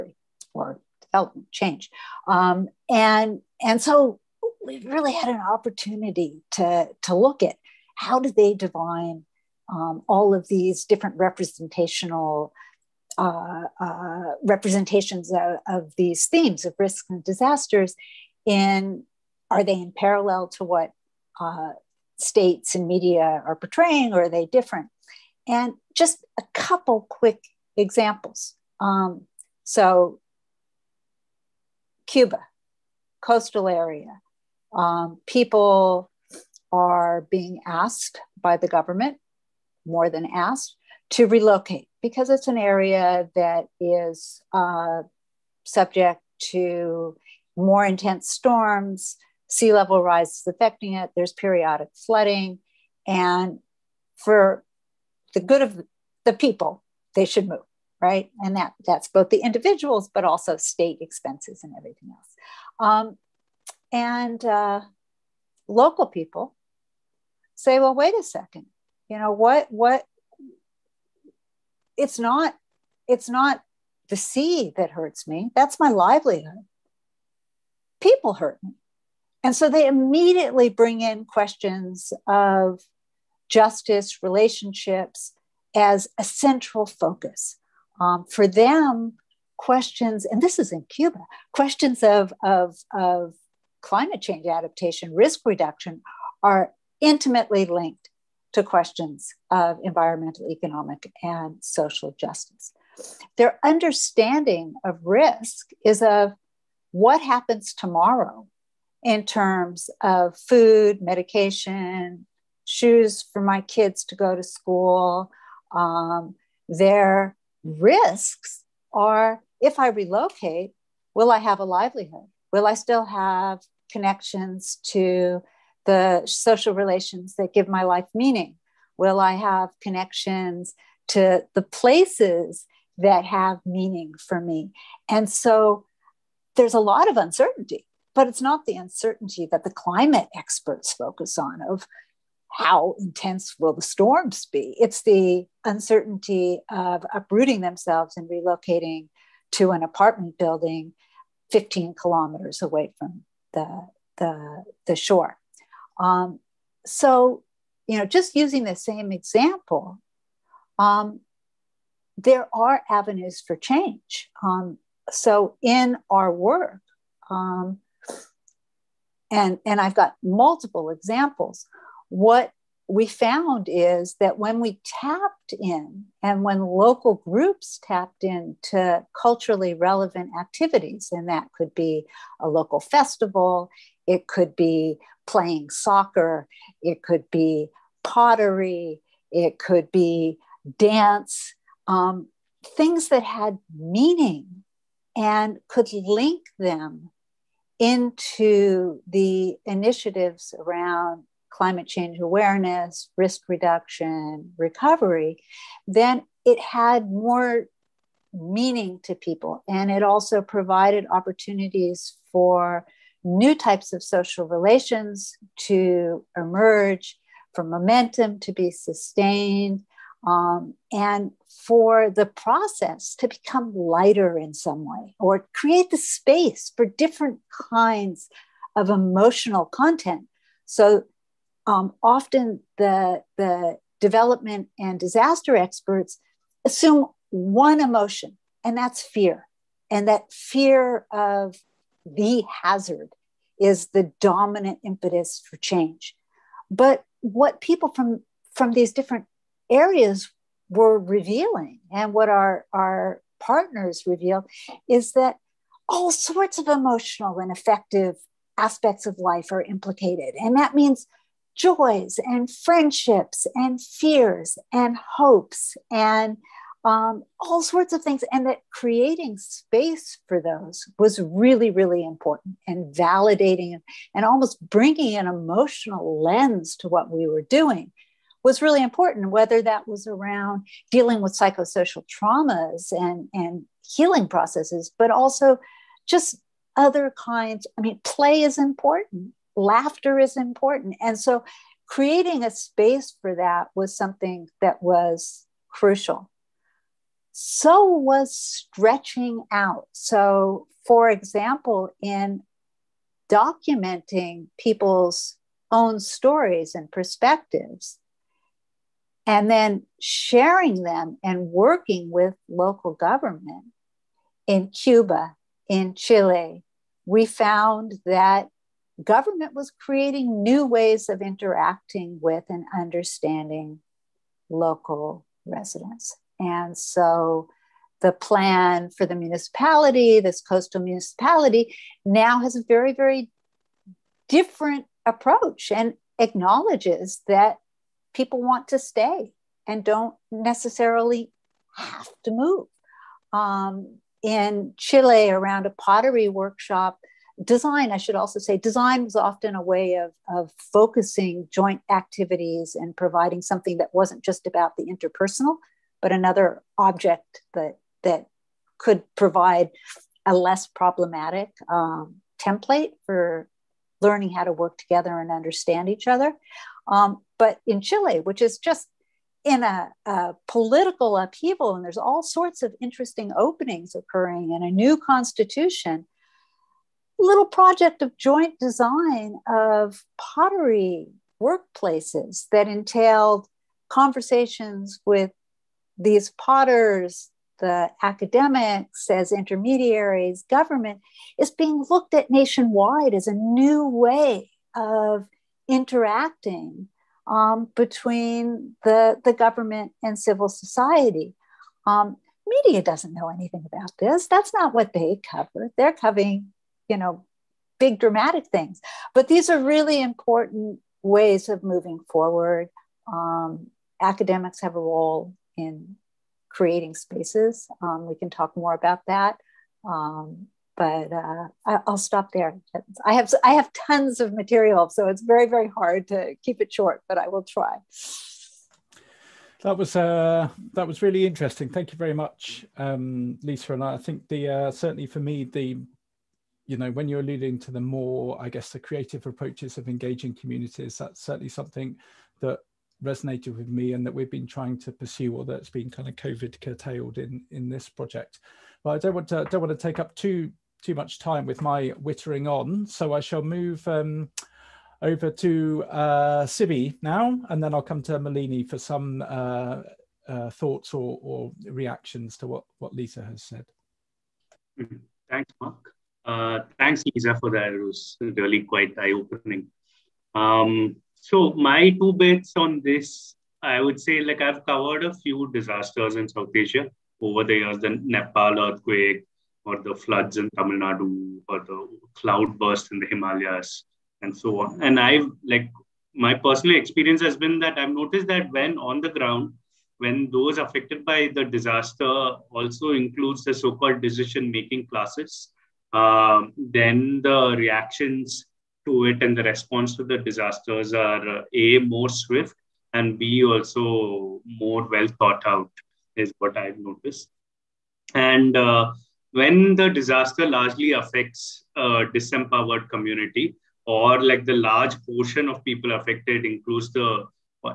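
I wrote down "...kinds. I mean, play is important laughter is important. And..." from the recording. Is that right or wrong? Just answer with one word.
right.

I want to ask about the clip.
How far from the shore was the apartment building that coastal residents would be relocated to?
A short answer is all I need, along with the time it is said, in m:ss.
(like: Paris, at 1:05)
15 kilometers, at 2:31.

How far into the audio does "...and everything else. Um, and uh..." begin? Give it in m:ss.
1:01.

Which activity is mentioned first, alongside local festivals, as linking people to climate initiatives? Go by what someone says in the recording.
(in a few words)
Playing soccer.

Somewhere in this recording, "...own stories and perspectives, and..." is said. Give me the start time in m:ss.
5:05.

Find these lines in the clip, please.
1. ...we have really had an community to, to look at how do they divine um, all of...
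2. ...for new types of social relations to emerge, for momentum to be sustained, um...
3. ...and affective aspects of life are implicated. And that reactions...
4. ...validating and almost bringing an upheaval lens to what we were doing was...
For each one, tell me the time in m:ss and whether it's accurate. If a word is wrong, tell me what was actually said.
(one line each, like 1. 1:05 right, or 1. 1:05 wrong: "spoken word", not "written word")
1. 0:04 wrong: "opportunity", not "community"
2. 3:32 right
3. 4:17 wrong: "means", not "reactions"
4. 4:32 wrong: "emotional", not "upheaval".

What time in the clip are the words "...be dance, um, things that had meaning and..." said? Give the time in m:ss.
3:09.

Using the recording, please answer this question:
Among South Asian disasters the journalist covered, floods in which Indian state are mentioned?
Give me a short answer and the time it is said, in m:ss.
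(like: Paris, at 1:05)
Tamil Nadu, at 8:00.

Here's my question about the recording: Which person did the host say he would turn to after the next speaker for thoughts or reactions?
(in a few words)
Malini.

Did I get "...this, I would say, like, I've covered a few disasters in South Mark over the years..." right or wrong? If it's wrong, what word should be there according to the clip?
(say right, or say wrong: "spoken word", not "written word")
wrong: "Asia", not "Mark".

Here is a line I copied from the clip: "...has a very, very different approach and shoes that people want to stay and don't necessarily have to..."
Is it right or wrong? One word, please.
wrong.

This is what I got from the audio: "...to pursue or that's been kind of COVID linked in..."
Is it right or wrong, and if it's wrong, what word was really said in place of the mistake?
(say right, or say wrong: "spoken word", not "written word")
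wrong: "curtailed", not "linked".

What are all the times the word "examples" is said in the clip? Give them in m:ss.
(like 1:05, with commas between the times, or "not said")
0:27, 2:39, 2:50, 5:01.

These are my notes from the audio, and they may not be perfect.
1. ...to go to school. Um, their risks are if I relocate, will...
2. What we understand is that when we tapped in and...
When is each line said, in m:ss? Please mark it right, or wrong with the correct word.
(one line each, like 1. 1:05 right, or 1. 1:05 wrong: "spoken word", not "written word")
1. 1:54 right
2. 2:52 wrong: "found", not "understand".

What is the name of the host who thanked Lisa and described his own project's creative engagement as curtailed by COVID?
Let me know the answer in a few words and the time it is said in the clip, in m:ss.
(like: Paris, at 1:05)
Mark, at 7:45.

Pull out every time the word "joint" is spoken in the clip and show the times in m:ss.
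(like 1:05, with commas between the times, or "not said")
5:51, 6:18.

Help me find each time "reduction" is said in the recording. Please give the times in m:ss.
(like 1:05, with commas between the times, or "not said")
1:35, 3:23.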